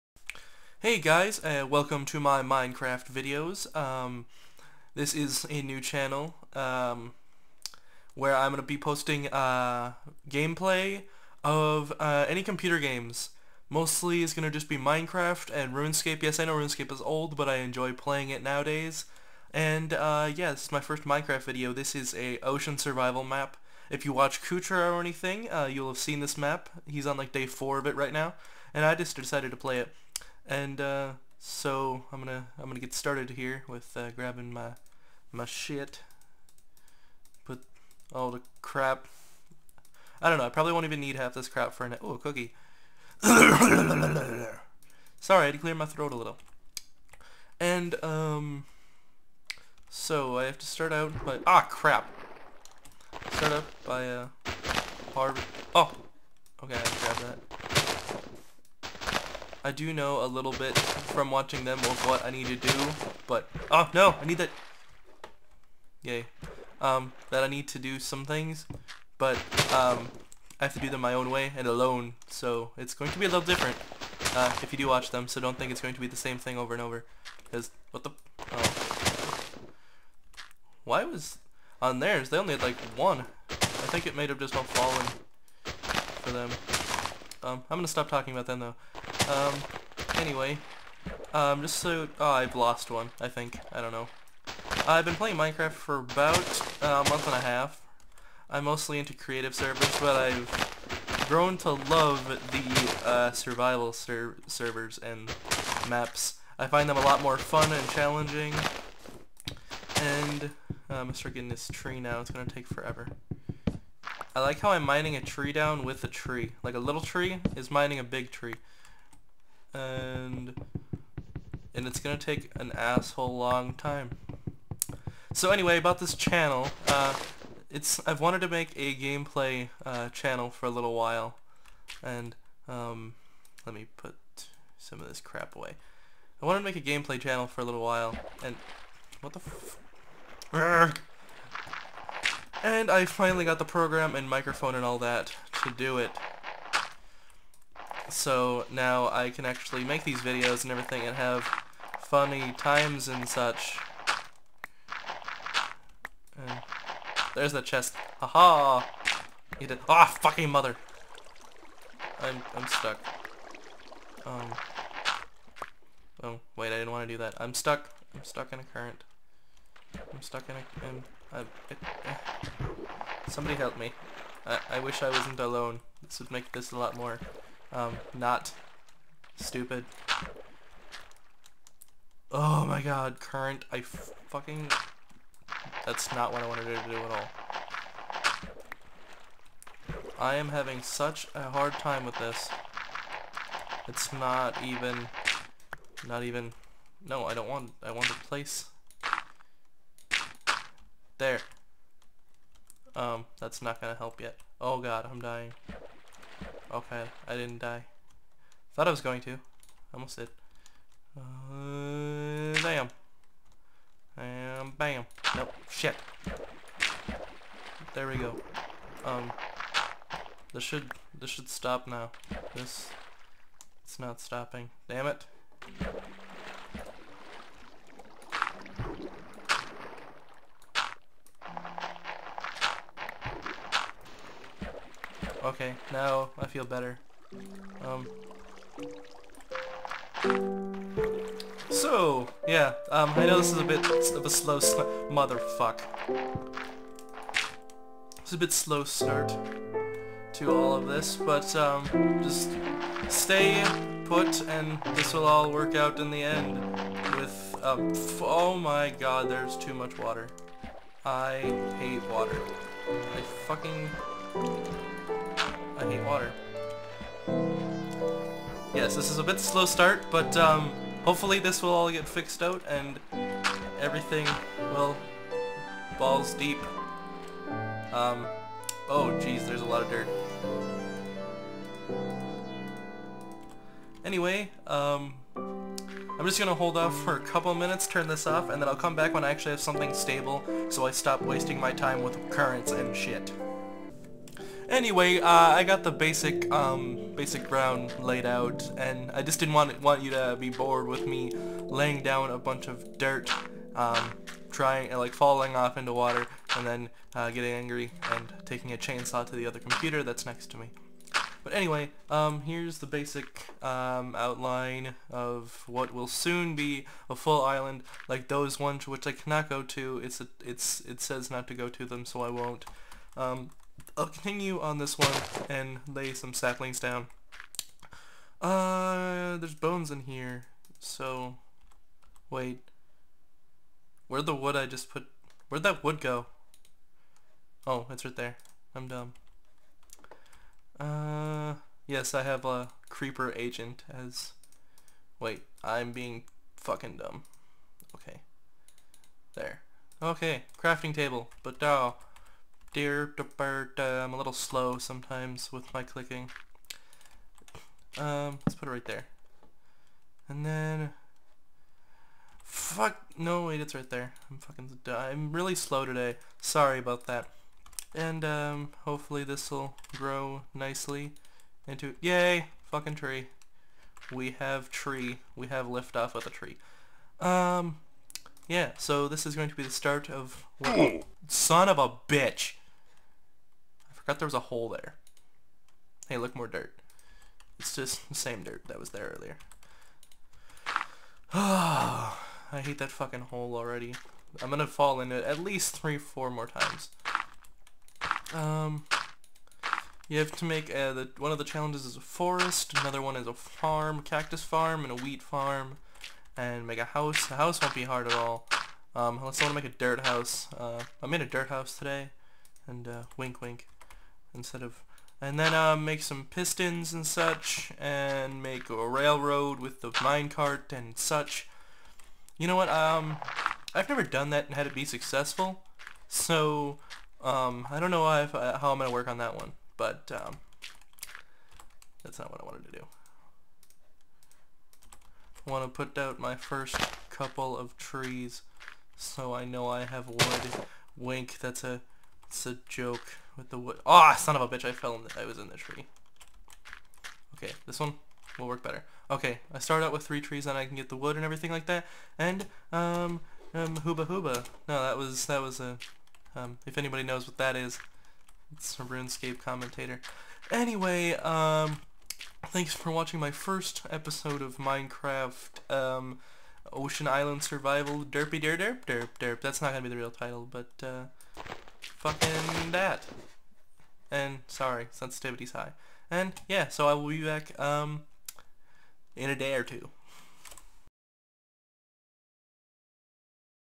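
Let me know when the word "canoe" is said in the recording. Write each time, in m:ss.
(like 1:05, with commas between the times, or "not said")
not said.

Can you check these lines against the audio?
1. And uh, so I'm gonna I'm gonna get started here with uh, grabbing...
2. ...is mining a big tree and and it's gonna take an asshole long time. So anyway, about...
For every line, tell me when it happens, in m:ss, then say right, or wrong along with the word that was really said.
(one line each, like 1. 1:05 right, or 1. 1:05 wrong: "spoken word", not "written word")
1. 0:30 right
2. 1:57 right.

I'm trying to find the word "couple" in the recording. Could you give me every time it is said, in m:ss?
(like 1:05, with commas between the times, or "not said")
4:47, 7:17.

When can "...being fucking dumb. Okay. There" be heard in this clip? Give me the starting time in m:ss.
5:45.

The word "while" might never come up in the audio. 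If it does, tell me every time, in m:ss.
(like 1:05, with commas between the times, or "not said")
2:10, 2:17.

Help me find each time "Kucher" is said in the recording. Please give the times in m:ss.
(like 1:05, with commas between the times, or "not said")
0:24.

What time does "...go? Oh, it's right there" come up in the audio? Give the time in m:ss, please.
5:36.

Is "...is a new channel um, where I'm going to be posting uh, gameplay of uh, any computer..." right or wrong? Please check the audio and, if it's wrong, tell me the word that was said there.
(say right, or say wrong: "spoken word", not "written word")
right.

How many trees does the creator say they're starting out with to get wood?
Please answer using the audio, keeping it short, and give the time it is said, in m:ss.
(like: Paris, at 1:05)
3, at 7:30.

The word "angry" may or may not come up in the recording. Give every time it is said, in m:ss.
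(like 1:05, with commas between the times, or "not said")
5:07.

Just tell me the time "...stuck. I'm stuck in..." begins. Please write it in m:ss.
2:47.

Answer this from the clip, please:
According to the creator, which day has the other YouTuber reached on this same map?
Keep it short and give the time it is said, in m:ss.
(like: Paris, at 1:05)
Day 4, at 0:27.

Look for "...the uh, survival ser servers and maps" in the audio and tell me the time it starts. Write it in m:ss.
1:42.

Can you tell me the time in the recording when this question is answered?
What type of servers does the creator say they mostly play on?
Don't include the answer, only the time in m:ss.
1:39.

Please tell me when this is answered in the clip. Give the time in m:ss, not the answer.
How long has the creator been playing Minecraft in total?
1:37.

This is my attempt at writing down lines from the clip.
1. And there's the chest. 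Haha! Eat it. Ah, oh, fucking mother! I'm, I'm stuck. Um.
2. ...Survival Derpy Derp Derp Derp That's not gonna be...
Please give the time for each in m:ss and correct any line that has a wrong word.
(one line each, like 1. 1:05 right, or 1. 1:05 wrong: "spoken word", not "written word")
1. 2:36 right
2. 7:47 right.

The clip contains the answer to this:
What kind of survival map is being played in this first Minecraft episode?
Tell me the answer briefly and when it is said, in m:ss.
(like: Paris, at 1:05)
Ocean survival map, at 0:22.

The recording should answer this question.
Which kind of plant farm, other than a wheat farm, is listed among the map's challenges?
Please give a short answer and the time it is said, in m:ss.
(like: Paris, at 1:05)
Cactus farm, at 6:44.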